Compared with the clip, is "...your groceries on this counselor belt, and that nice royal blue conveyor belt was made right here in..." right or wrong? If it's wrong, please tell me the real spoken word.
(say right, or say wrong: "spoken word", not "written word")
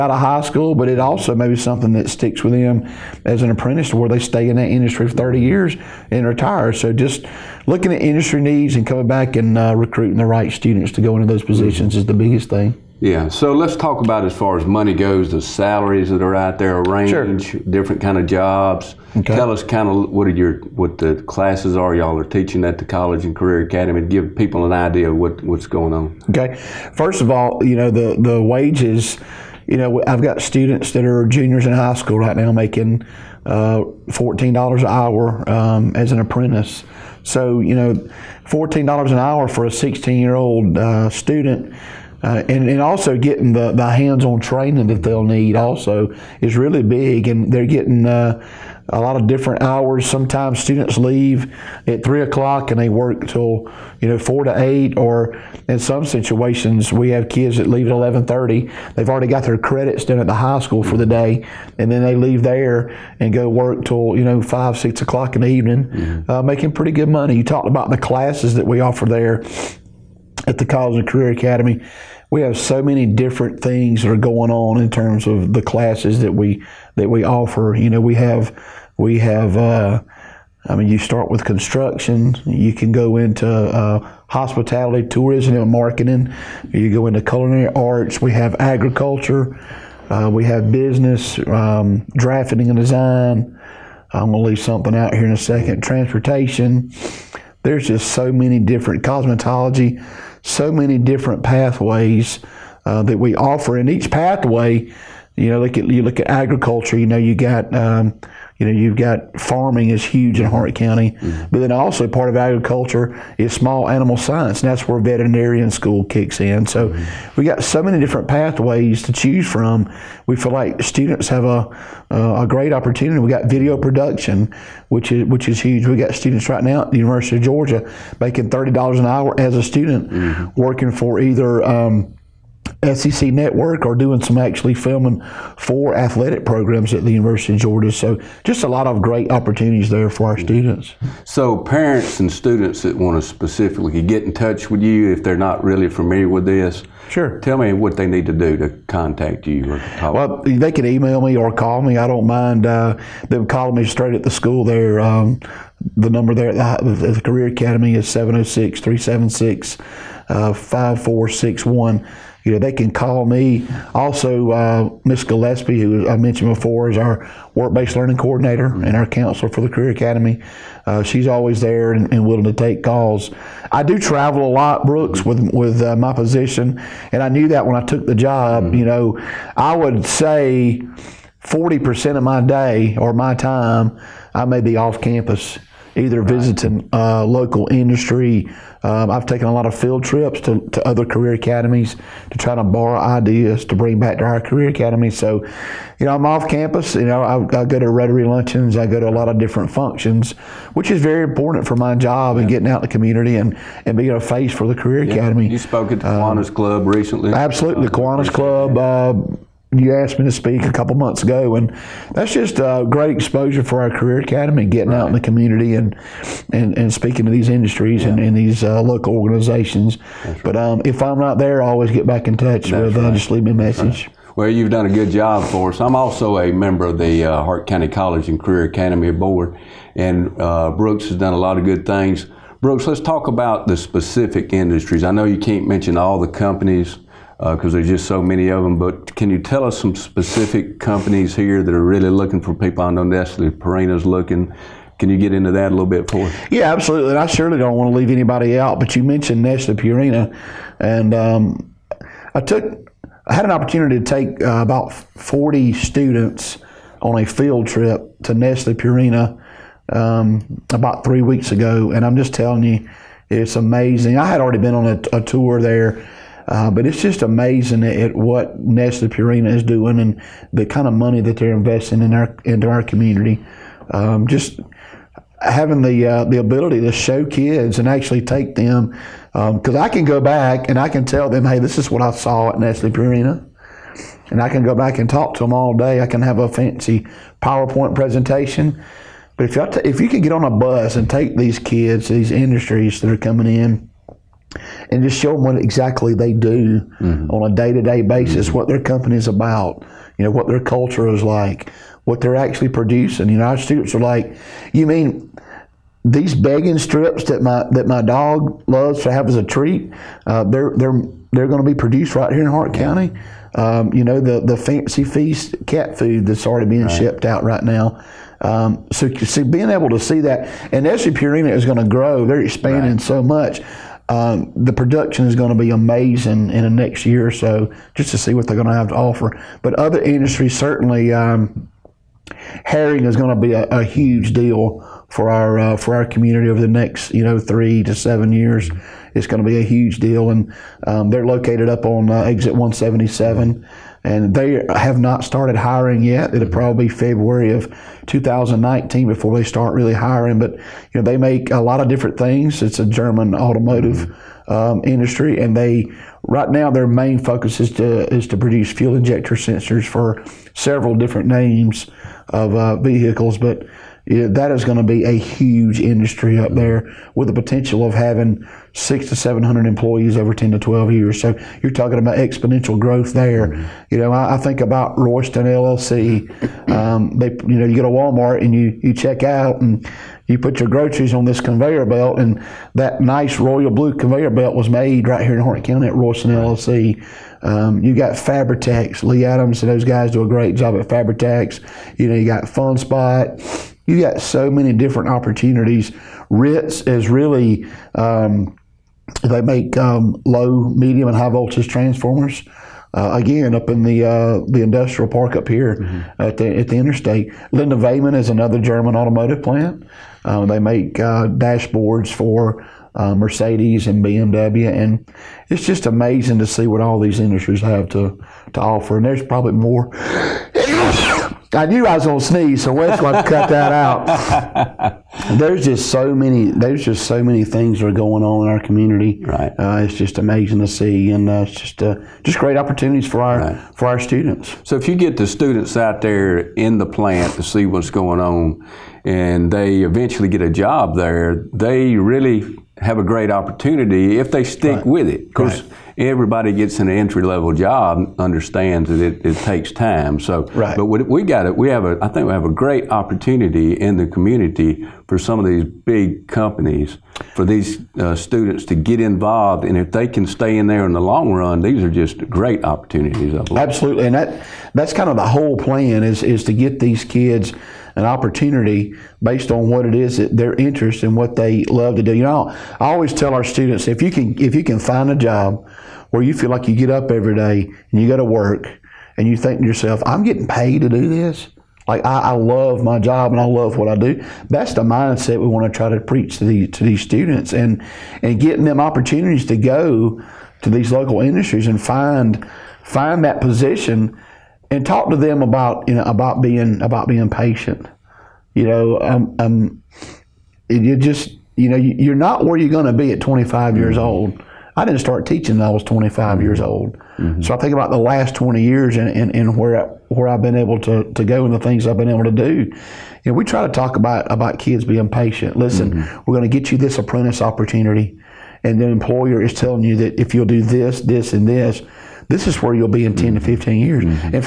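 wrong: "conveyor", not "counselor".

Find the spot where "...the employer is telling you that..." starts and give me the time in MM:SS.
08:38.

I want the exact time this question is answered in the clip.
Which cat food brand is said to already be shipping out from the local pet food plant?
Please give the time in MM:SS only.
05:14.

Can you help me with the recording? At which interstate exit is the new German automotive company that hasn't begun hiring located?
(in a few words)
Exit 177.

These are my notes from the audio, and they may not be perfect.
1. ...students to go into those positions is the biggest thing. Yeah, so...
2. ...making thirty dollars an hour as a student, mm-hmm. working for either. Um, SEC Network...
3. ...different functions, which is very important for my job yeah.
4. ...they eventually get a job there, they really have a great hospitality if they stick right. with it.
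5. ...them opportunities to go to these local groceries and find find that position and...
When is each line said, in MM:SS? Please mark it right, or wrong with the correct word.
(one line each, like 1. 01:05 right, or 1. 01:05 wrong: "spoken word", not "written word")
1. 00:10 right
2. 02:08 right
3. 03:19 right
4. 07:19 wrong: "opportunity", not "hospitality"
5. 08:08 wrong: "industries", not "groceries".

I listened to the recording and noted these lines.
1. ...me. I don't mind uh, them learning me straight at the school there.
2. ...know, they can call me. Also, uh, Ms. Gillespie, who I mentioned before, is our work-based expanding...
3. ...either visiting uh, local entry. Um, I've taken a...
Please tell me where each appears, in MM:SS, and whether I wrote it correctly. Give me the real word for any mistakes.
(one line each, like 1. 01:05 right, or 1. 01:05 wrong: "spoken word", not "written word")
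1. 02:31 wrong: "calling", not "learning"
2. 02:42 wrong: "learning", not "expanding"
3. 03:05 wrong: "industry", not "entry".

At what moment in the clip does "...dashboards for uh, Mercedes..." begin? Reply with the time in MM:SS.
06:51.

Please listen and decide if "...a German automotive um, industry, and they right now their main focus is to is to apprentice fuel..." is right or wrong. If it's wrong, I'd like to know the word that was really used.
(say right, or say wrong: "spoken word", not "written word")
wrong: "produce", not "apprentice".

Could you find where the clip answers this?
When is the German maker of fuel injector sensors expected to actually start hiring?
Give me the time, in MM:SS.
05:46.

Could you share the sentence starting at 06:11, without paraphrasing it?
So you're talking about exponential growth there.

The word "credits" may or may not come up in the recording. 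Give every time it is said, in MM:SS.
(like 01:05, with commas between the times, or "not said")
00:59.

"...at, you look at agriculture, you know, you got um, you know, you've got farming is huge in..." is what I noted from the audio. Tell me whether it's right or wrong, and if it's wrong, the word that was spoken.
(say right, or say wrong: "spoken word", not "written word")
right.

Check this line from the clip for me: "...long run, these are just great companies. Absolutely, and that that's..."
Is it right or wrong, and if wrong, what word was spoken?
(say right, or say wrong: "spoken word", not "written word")
wrong: "opportunities", not "companies".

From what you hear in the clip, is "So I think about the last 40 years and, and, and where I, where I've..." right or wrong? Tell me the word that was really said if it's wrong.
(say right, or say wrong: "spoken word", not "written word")
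wrong: "20", not "40".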